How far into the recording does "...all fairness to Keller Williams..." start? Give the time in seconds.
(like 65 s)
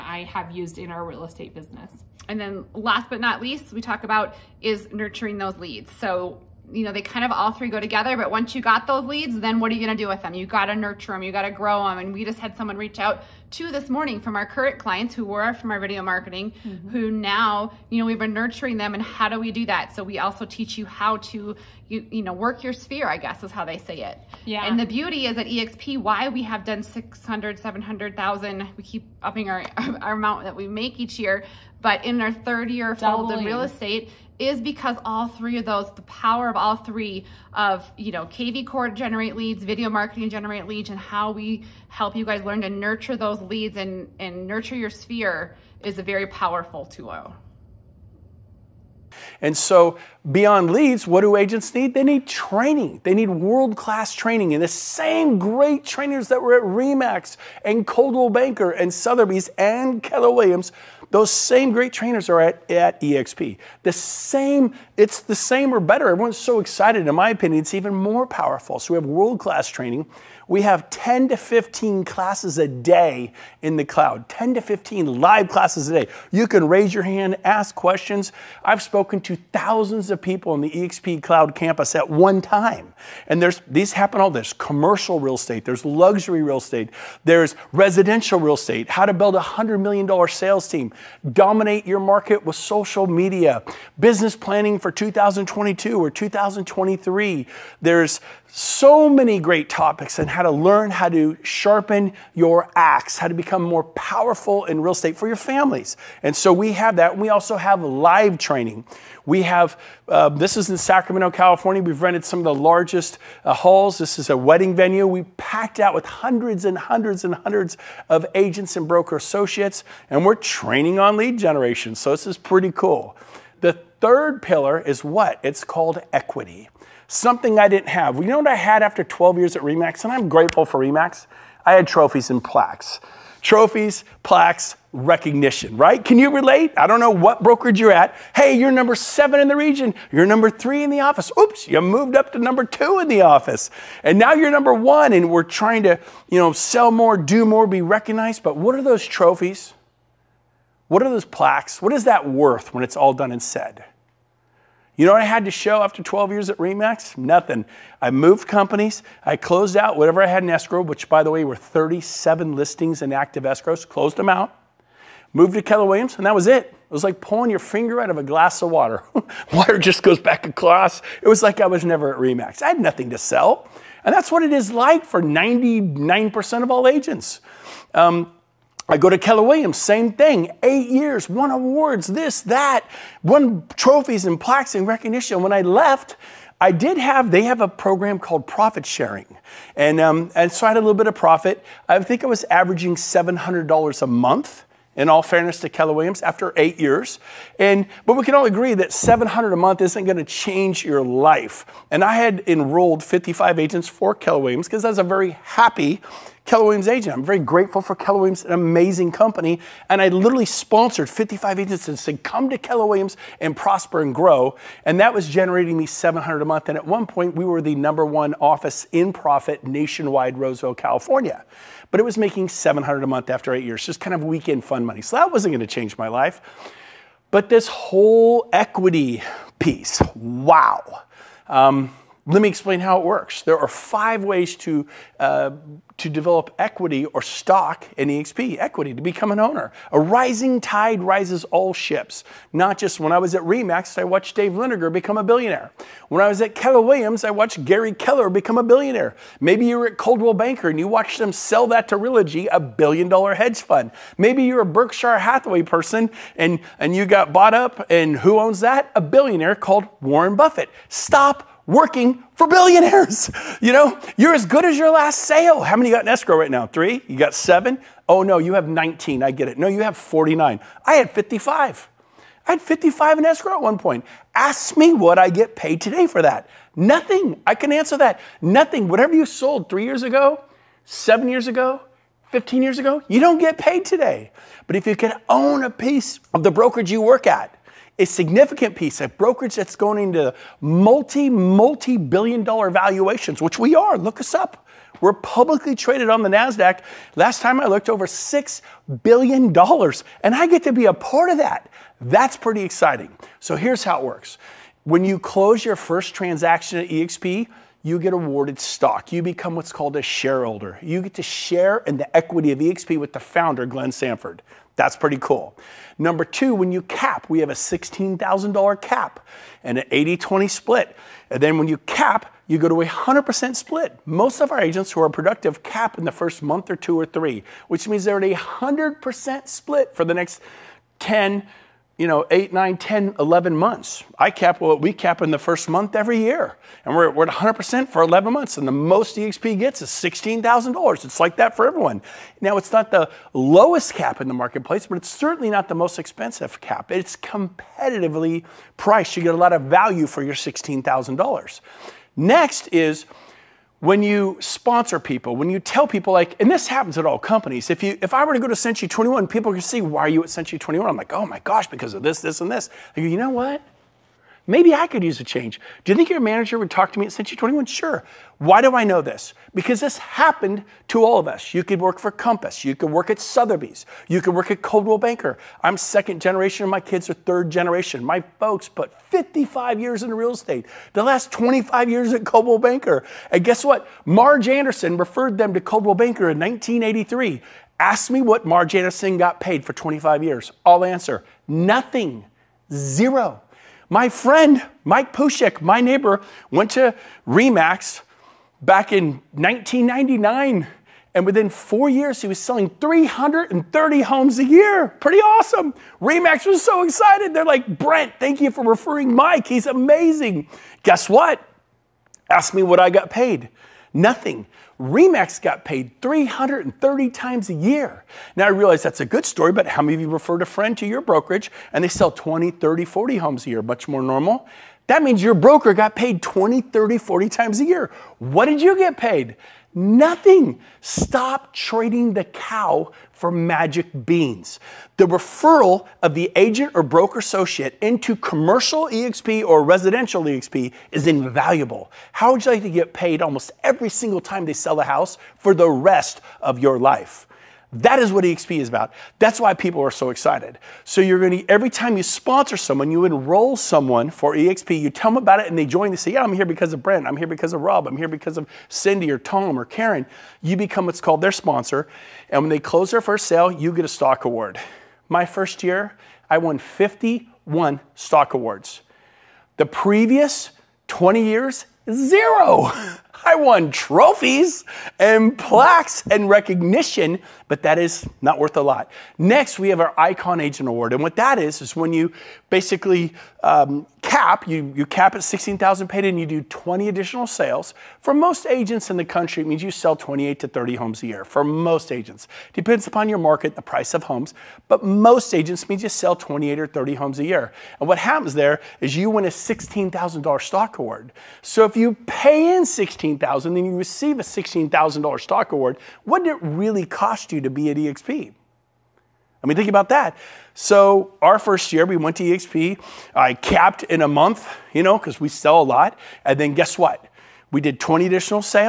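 195 s.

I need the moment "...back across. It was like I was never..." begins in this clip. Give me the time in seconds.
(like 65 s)
170 s.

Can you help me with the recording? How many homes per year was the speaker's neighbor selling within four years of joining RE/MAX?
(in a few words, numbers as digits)
330.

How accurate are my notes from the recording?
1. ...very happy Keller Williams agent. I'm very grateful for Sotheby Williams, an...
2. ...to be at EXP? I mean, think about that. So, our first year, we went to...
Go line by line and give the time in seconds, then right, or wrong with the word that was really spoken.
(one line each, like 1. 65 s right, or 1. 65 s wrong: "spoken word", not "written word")
1. 205 s wrong: "Keller", not "Sotheby"
2. 507 s right.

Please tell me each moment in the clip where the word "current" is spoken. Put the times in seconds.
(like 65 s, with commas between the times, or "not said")
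14 s.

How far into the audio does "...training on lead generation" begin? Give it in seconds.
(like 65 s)
120 s.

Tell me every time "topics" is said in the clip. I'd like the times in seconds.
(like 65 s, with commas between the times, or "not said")
99 s.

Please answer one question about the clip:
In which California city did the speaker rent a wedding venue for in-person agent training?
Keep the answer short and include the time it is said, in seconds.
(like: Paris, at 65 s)
Sacramento, at 110 s.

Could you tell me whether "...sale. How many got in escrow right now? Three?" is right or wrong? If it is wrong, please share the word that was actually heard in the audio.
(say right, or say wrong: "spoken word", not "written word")
right.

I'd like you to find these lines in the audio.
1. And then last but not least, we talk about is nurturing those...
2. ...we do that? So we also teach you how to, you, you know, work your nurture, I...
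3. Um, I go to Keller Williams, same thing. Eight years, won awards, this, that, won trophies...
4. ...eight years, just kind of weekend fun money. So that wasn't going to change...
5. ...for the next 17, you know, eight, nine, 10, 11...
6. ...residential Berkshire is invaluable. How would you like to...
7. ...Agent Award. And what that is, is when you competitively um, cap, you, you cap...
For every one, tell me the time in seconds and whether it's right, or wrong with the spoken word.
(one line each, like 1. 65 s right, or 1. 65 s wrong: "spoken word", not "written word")
1. 2 s right
2. 19 s wrong: "sphere", not "nurture"
3. 177 s right
4. 223 s right
5. 329 s wrong: "10", not "17"
6. 439 s wrong: "EXP", not "Berkshire"
7. 480 s wrong: "basically", not "competitively".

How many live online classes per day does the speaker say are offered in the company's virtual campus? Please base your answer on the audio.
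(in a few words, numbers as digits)
10 to 15.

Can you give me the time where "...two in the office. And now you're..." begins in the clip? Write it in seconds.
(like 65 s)
142 s.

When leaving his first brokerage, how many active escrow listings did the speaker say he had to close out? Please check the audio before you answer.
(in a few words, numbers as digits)
37.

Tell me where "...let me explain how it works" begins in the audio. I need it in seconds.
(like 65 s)
232 s.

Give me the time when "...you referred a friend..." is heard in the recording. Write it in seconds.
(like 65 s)
420 s.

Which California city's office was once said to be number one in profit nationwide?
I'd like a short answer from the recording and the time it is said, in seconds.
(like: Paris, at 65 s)
Roseville, at 220 s.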